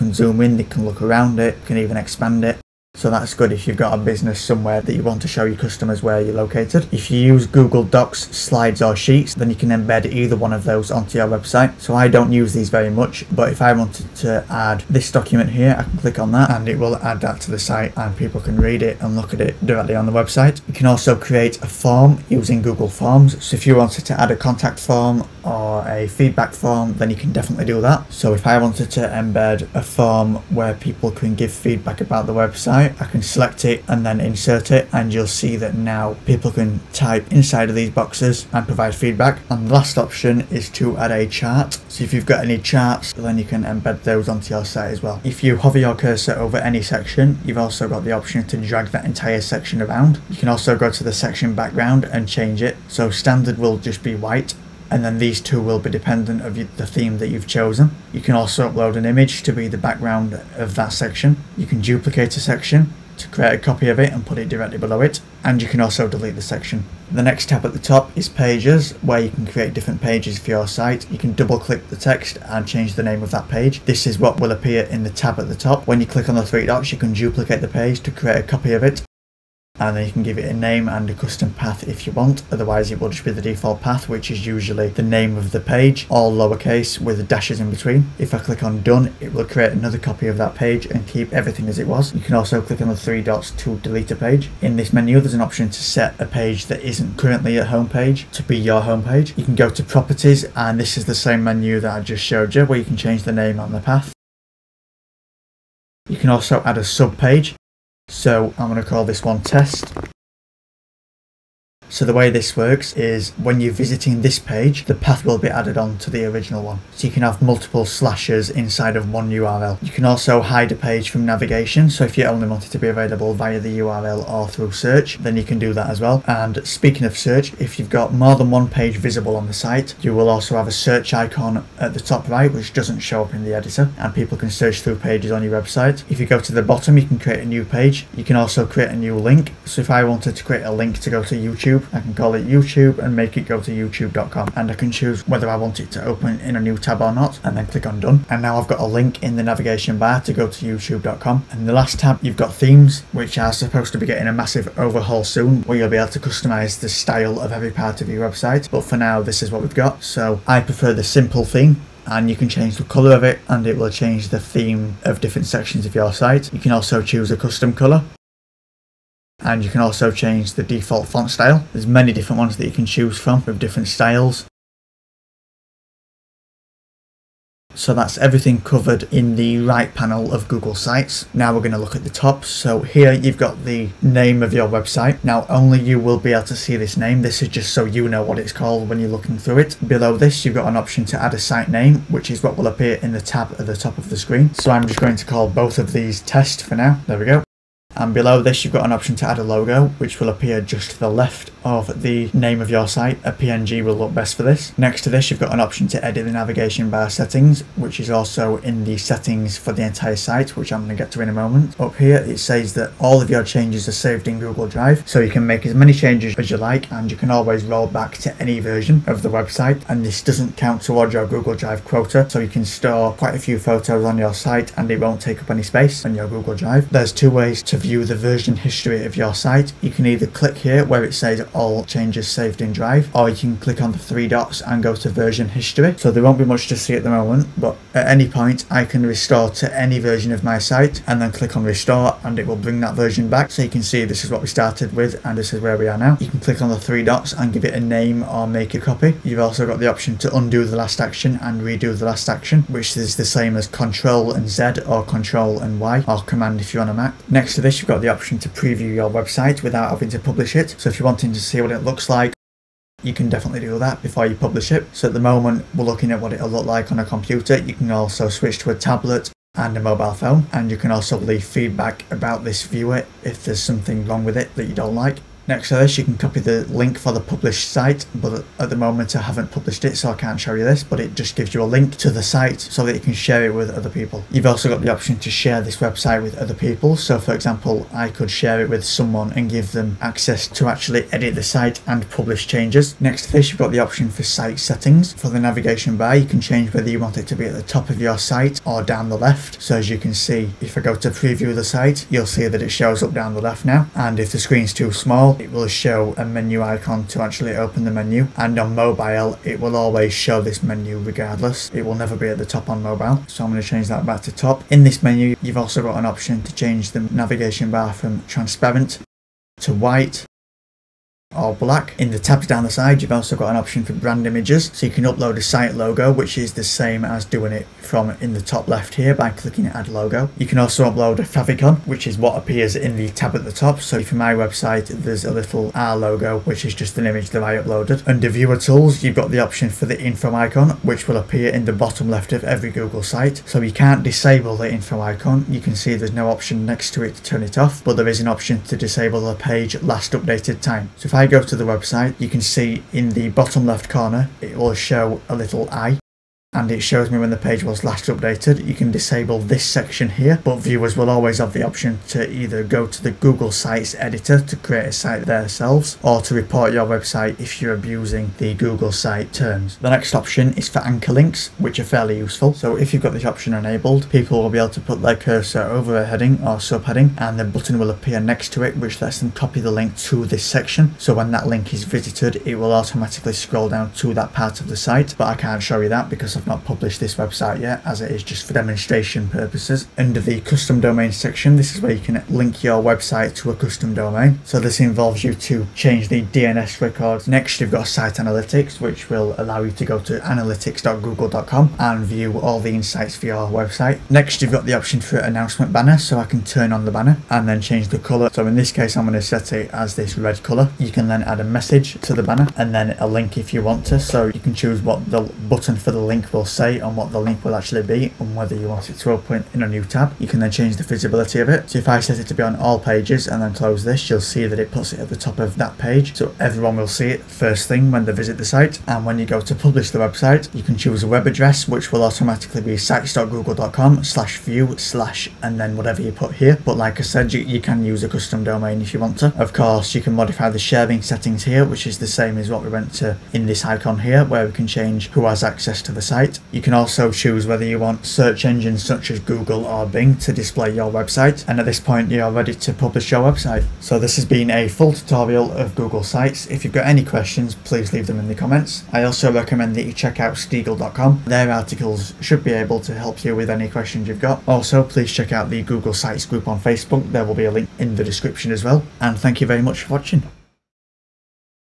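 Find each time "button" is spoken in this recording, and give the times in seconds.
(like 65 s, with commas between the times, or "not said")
377 s, 415 s.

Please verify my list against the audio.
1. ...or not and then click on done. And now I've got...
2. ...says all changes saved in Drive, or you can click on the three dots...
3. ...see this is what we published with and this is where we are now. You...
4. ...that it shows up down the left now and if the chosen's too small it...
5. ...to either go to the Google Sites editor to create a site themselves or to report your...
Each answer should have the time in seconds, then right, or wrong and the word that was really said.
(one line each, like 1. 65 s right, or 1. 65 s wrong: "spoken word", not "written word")
1. 147 s right
2. 231 s right
3. 243 s wrong: "started", not "published"
4. 302 s wrong: "screen", not "chosen"
5. 362 s right.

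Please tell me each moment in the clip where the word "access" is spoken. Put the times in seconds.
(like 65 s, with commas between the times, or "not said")
289 s, 445 s.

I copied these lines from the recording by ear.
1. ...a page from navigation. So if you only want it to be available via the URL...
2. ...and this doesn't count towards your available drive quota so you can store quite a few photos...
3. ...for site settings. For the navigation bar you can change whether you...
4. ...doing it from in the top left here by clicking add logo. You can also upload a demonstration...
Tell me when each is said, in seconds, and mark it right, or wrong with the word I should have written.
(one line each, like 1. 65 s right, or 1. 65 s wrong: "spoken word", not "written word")
1. 120 s right
2. 219 s wrong: "google", not "available"
3. 294 s right
4. 327 s wrong: "favicon", not "demonstration".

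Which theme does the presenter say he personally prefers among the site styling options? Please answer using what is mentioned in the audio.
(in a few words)
Simple.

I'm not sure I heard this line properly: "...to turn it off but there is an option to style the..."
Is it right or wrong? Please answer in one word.
wrong.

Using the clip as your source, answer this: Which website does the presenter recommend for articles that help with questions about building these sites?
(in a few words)
Steegle.com.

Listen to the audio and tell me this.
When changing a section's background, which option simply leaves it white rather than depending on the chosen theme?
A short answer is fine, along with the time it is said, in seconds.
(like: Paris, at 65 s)
Standard, at 53 s.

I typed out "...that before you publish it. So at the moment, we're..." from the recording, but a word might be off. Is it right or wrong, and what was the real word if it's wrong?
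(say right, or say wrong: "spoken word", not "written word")
right.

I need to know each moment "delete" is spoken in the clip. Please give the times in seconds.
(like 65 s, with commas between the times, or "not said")
66 s, 93 s.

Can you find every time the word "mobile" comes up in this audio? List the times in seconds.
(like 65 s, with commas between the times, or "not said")
269 s, 308 s, 312 s.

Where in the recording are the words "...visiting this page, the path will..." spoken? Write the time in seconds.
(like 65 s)
113 s.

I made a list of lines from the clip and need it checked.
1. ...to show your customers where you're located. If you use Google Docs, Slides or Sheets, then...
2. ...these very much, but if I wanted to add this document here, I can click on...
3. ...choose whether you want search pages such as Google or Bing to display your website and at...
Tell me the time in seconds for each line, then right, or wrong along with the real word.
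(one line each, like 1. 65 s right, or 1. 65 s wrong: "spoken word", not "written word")
1. 5 s right
2. 12 s right
3. 447 s wrong: "engines", not "pages".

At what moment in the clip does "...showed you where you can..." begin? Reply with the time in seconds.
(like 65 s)
102 s.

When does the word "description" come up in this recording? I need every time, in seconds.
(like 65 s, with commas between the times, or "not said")
468 s.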